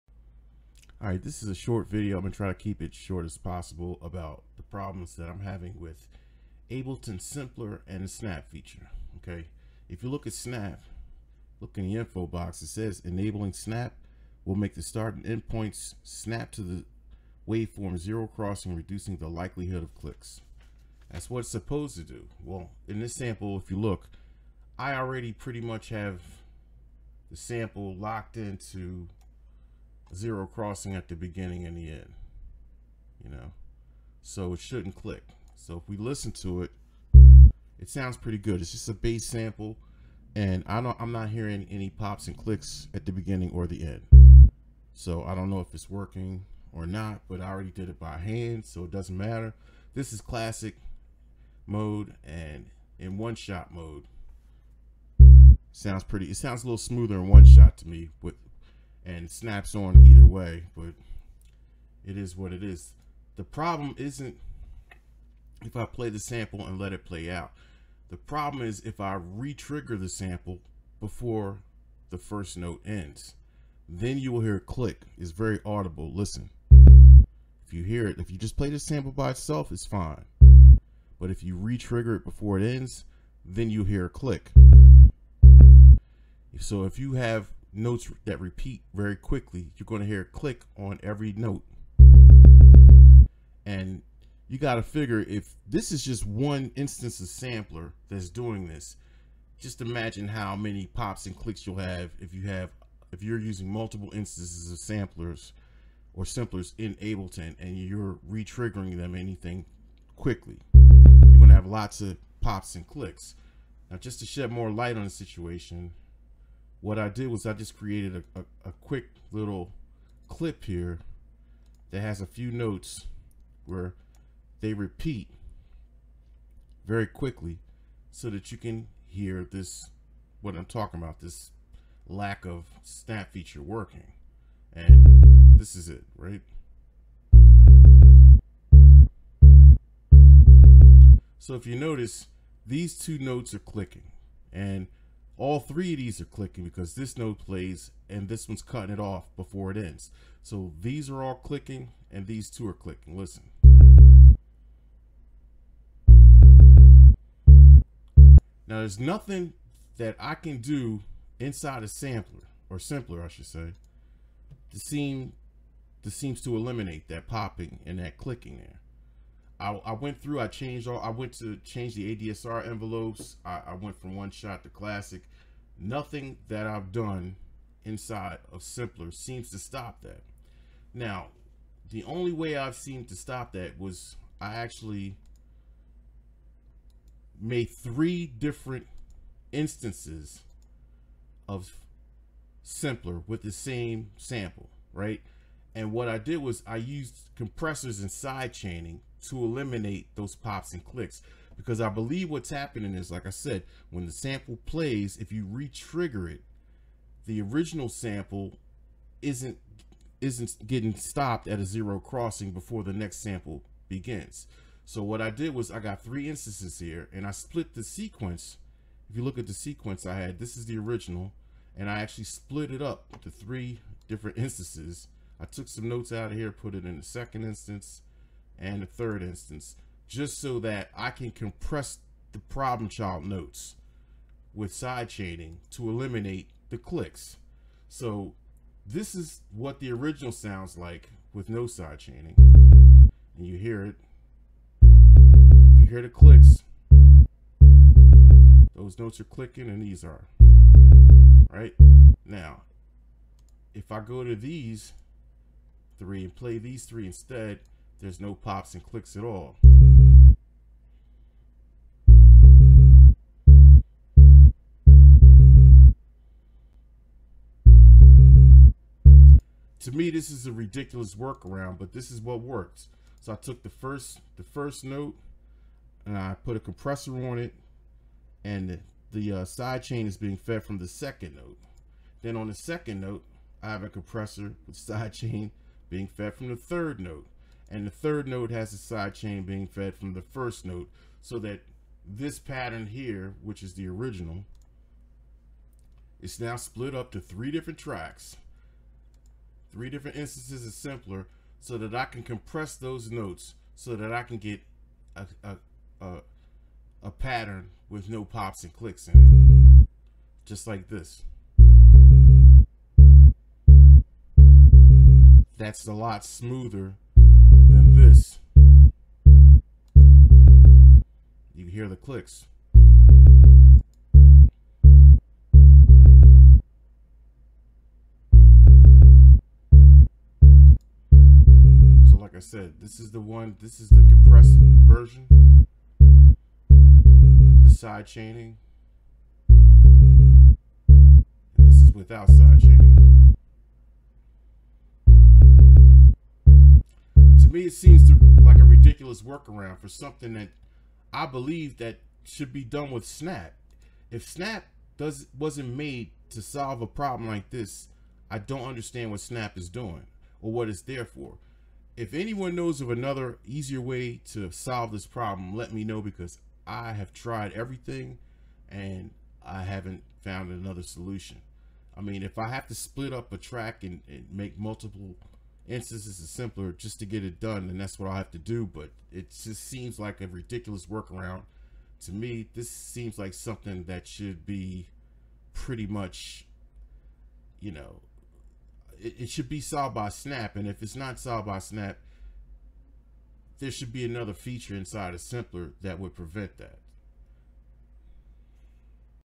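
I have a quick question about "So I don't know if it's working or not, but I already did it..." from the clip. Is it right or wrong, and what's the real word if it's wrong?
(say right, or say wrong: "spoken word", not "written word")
right.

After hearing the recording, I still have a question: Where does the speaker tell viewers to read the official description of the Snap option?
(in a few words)
info box.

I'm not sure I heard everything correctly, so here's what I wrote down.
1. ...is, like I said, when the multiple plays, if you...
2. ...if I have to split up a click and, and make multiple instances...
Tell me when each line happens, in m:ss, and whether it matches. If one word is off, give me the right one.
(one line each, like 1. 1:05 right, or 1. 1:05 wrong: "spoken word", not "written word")
1. 3:22 wrong: "sample", not "multiple"
2. 6:12 wrong: "track", not "click".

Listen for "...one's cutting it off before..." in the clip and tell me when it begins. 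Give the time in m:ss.
2:28.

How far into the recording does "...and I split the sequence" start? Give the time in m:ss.
3:37.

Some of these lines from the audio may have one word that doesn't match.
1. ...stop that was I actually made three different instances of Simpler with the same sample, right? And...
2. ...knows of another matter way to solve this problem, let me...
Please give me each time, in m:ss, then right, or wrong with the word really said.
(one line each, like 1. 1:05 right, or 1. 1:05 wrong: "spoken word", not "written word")
1. 3:03 right
2. 6:02 wrong: "easier", not "matter".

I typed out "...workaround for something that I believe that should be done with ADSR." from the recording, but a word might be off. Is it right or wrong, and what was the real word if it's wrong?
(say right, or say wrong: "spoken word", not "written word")
wrong: "Snap", not "ADSR".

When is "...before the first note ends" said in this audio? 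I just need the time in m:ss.
1:10.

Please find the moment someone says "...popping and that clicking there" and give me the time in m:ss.
2:47.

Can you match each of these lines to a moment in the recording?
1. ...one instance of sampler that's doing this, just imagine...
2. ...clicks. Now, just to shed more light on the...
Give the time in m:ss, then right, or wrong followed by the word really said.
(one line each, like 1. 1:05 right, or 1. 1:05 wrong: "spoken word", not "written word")
1. 1:36 right
2. 1:52 right.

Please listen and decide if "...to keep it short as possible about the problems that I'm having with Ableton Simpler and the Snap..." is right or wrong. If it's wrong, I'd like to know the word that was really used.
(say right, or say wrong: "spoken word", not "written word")
right.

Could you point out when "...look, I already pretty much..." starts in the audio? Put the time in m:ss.
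0:23.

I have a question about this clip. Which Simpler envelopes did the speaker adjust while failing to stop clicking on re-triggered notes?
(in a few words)
ADSR envelopes.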